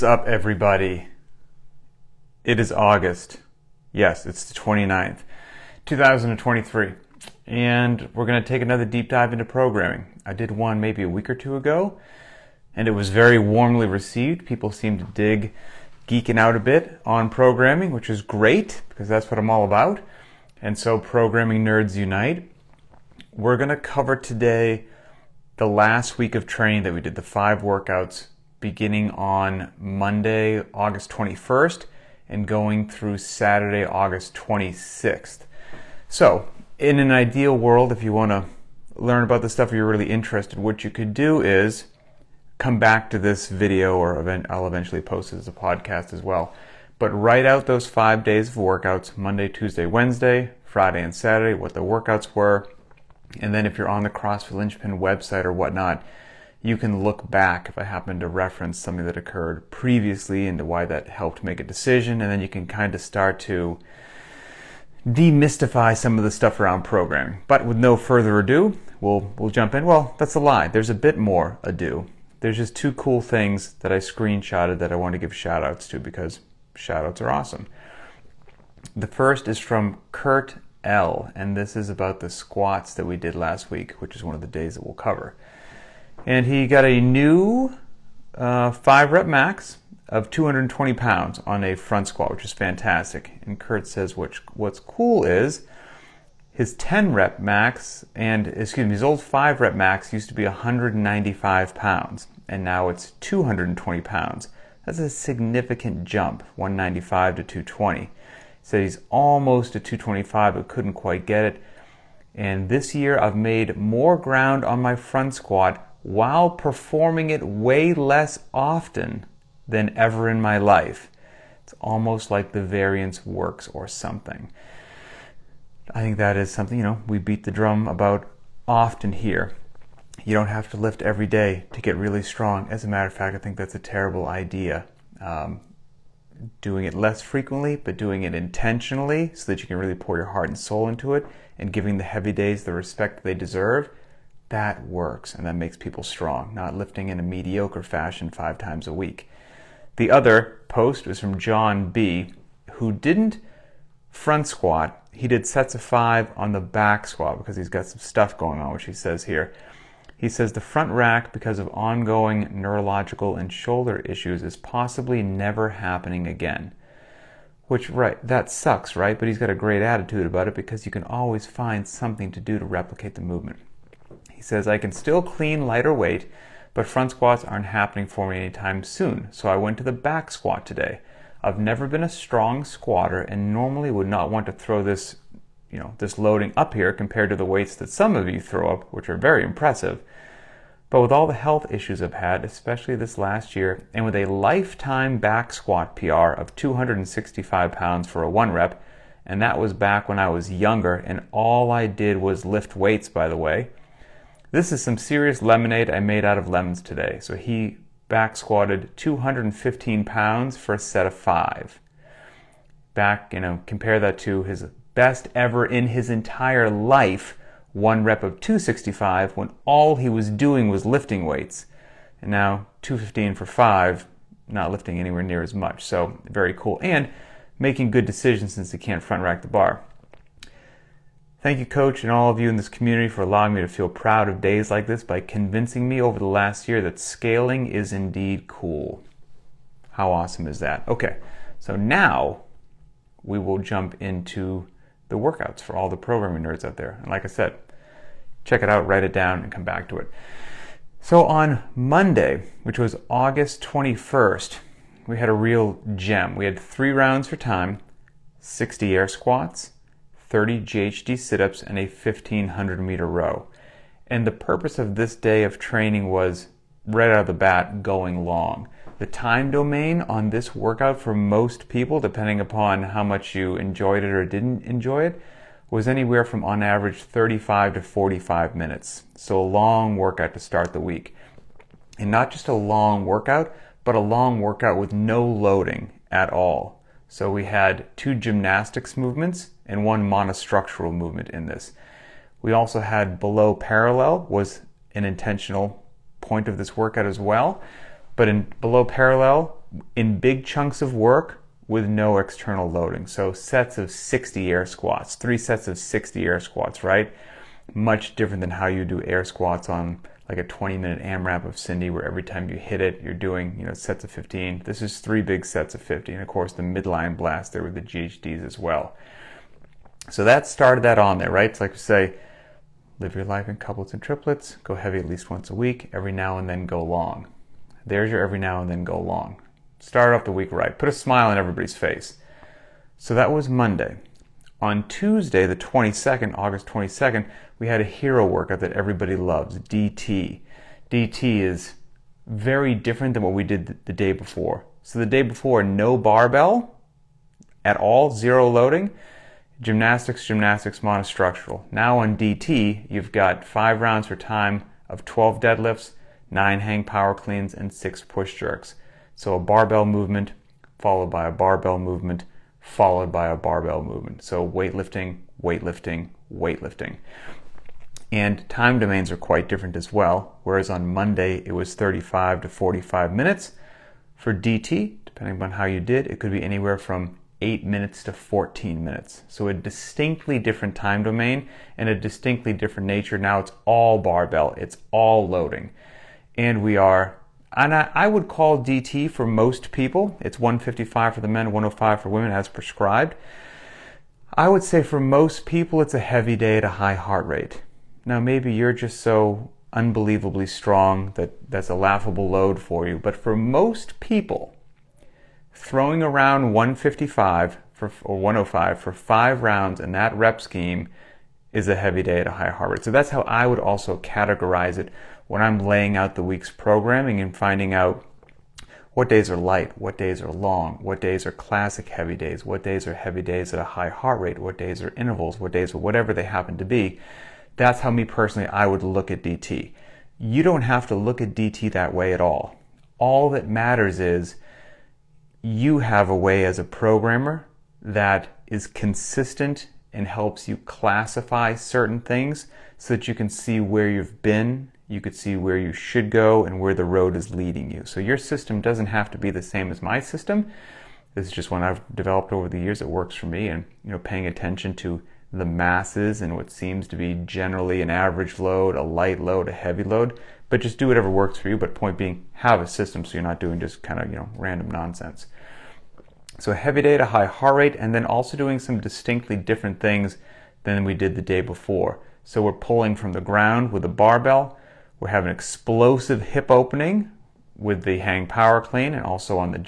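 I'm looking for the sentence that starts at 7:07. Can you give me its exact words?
That's how me personally I would look at DT.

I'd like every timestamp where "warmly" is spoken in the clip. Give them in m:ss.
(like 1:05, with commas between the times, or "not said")
0:13.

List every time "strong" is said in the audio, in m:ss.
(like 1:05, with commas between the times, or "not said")
2:12, 2:26, 3:02, 6:40.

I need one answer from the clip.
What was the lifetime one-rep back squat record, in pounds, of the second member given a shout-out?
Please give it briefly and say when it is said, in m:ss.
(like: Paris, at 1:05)
265, at 3:16.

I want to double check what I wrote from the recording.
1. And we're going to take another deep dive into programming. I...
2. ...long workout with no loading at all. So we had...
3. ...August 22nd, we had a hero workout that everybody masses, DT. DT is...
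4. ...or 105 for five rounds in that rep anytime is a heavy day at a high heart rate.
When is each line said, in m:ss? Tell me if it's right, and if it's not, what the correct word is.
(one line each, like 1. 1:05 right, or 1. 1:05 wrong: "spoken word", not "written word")
1. 0:07 right
2. 4:43 right
3. 5:36 wrong: "loves", not "masses"
4. 6:48 wrong: "scheme", not "anytime".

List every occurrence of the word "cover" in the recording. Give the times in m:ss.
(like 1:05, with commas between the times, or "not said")
0:23, 1:24.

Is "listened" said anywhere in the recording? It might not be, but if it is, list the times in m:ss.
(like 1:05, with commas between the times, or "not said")
not said.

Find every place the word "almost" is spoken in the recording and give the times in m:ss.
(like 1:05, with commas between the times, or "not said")
1:49, 2:01.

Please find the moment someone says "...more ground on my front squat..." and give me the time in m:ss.
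1:53.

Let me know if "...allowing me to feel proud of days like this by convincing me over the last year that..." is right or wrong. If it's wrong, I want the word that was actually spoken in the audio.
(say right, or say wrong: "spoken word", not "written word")
right.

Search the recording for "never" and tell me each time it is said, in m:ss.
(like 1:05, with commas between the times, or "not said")
2:45, 3:01.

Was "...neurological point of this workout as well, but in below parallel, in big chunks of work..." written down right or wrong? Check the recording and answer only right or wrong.
wrong.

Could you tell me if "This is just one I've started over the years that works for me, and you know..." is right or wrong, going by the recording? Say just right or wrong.
wrong.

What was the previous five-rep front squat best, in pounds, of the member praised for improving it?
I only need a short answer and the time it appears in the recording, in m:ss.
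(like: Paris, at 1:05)
195, at 1:40.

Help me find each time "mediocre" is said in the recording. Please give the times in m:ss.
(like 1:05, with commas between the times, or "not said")
2:27.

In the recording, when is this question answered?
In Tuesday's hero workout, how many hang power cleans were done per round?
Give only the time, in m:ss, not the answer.
5:56.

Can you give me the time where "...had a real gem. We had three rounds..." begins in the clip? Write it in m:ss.
4:15.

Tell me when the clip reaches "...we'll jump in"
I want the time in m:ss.
1:09.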